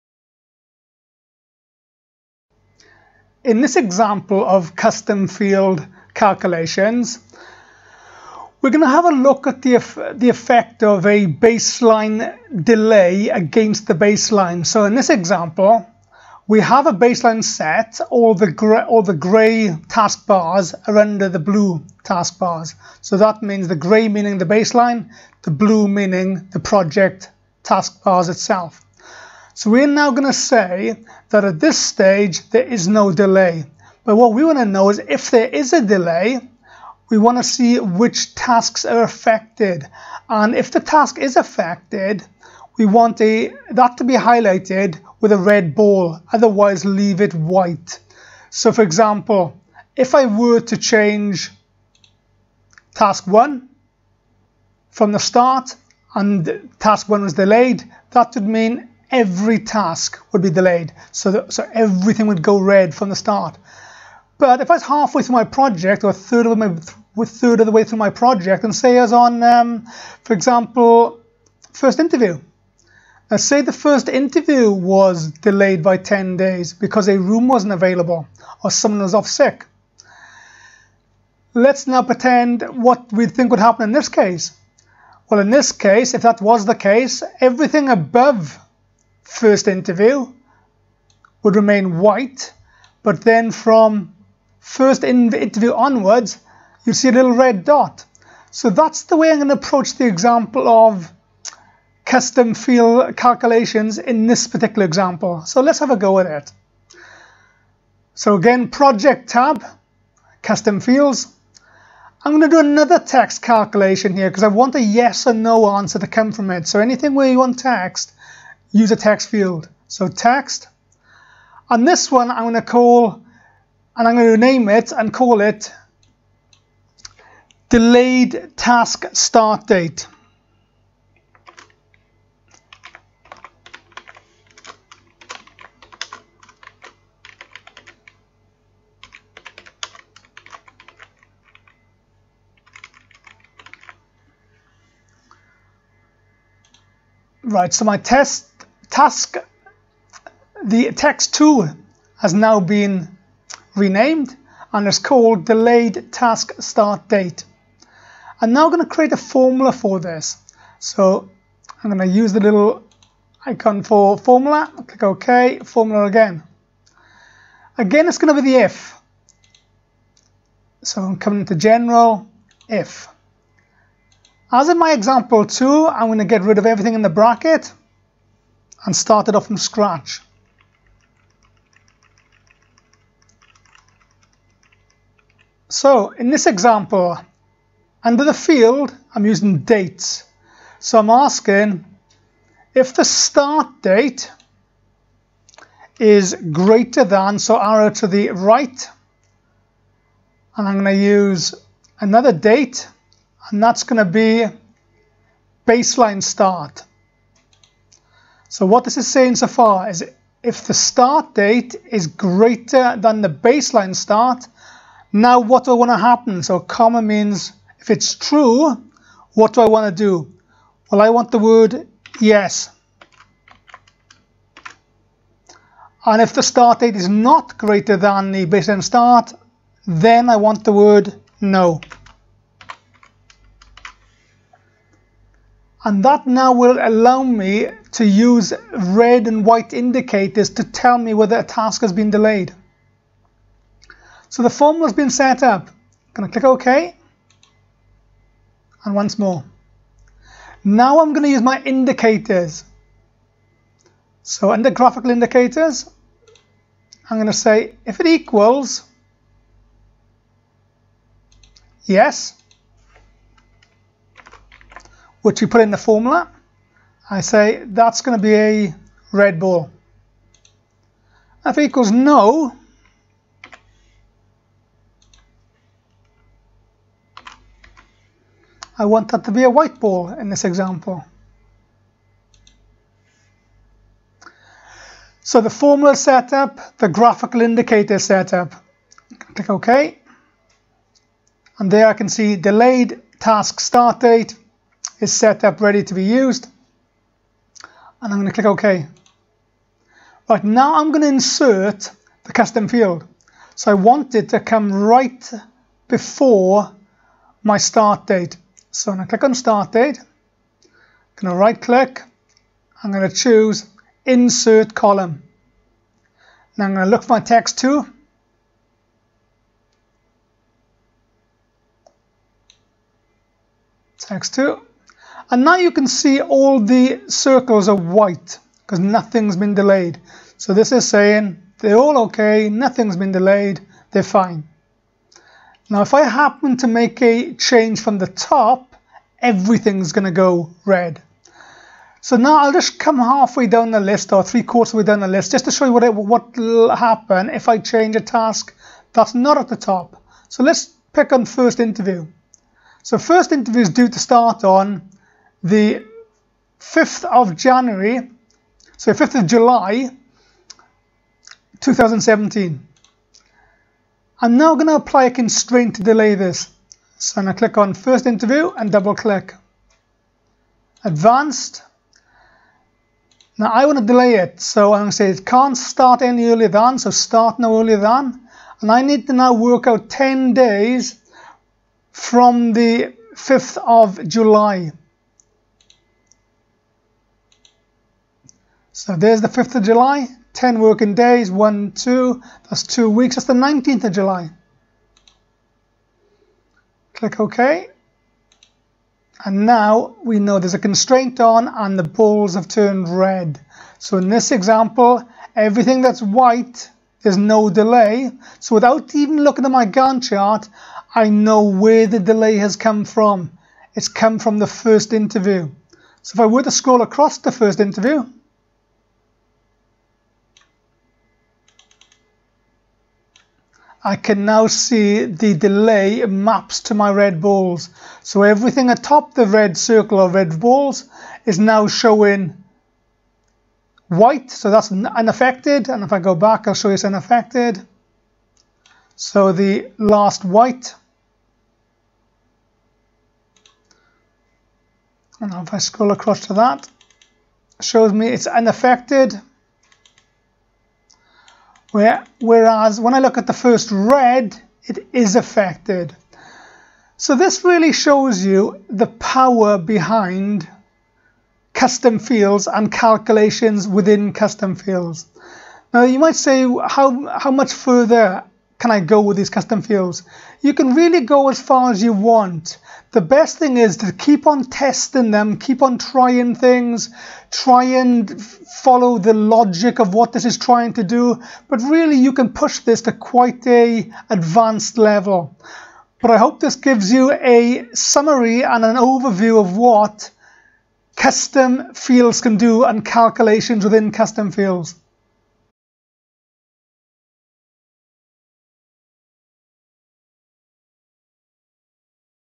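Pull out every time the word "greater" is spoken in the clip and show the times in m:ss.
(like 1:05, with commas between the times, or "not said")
3:16, 3:32, 3:47.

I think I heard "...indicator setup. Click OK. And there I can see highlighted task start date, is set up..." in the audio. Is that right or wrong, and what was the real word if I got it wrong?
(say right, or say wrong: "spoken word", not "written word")
wrong: "delayed", not "highlighted".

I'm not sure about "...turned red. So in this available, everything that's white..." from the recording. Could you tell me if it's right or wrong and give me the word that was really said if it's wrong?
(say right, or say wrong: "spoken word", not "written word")
wrong: "example", not "available".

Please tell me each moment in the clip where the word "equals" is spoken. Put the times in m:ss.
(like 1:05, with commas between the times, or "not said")
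4:18, 4:31.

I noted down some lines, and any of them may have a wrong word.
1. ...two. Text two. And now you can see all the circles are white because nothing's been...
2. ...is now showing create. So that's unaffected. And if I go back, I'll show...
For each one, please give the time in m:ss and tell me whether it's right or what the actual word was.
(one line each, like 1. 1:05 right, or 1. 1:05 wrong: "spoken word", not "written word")
1. 5:17 right
2. 7:11 wrong: "white", not "create".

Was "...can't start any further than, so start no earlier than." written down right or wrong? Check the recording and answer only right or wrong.
wrong.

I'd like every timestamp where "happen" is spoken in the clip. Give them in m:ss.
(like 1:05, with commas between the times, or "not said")
1:23, 3:35, 5:36, 5:46.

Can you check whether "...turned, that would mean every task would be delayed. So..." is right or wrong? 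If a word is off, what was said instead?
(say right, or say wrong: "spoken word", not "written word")
wrong: "delayed", not "turned".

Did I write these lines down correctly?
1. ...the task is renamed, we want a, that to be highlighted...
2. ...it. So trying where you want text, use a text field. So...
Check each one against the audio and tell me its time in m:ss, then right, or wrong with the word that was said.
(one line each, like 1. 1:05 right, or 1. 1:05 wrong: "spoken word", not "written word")
1. 0:40 wrong: "affected", not "renamed"
2. 1:56 wrong: "anything", not "trying".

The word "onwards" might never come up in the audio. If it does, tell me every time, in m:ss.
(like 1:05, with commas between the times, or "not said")
1:35.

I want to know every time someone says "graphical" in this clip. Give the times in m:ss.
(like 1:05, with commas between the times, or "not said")
4:14, 4:46.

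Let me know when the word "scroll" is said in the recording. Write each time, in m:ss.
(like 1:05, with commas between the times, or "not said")
6:56, 7:25.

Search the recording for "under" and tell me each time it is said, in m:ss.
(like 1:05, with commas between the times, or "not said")
0:20, 3:08, 4:14.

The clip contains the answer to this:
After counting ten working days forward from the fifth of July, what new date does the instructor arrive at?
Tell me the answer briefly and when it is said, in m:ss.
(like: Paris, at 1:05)
19 July, at 6:33.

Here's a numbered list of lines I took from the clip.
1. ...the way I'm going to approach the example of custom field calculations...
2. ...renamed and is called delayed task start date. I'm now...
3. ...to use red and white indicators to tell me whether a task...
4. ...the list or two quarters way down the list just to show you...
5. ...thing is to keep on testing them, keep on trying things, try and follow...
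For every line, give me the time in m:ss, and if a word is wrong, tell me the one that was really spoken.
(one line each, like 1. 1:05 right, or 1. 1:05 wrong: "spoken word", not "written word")
1. 1:39 right
2. 2:33 right
3. 3:57 right
4. 5:43 wrong: "three", not "two"
5. 7:53 right.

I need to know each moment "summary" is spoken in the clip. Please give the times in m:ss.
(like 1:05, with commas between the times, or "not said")
8:07.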